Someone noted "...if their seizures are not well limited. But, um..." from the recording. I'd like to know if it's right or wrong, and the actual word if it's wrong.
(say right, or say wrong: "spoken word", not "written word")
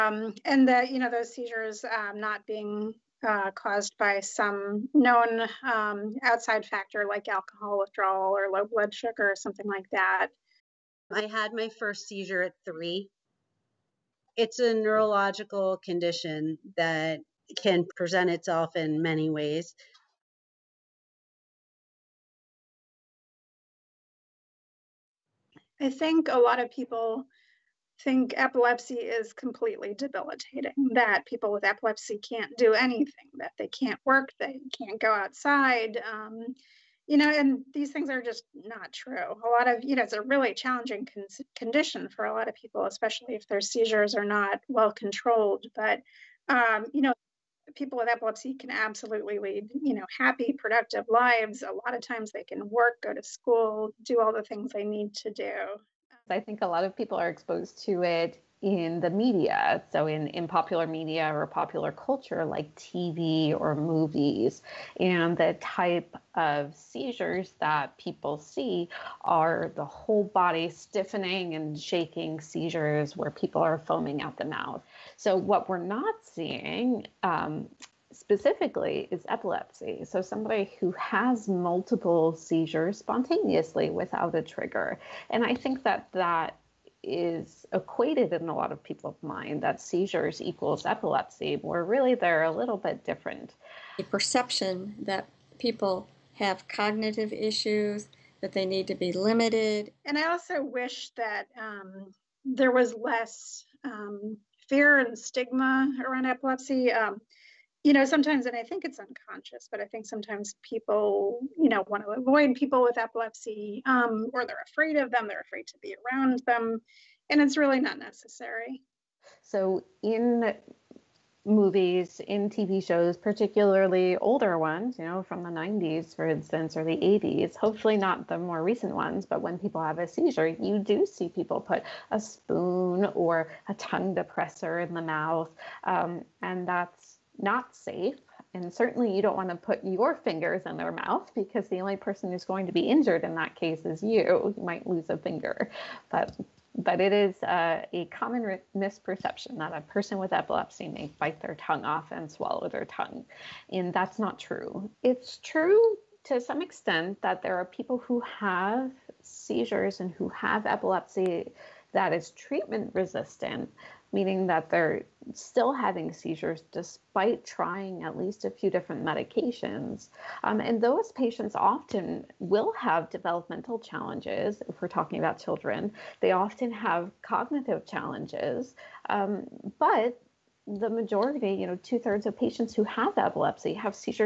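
wrong: "controlled", not "limited".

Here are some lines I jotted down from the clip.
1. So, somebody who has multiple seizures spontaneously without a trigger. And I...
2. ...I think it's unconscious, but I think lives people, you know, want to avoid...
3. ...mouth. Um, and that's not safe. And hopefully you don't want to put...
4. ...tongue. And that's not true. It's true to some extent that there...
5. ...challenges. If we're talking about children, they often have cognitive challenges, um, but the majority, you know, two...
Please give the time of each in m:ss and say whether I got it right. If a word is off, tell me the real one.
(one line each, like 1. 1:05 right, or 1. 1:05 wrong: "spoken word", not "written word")
1. 1:20 right
2. 1:48 wrong: "sometimes", not "lives"
3. 2:15 wrong: "certainly", not "hopefully"
4. 2:32 right
5. 2:53 right.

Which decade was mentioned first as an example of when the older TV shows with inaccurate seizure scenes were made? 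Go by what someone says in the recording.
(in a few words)
90s.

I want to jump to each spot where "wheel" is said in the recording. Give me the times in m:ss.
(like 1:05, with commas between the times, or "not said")
not said.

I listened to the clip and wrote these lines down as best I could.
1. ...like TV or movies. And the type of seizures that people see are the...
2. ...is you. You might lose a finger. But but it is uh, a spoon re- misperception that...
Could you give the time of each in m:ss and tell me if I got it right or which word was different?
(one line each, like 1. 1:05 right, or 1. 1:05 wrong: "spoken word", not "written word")
1. 1:02 right
2. 2:23 wrong: "common", not "spoon".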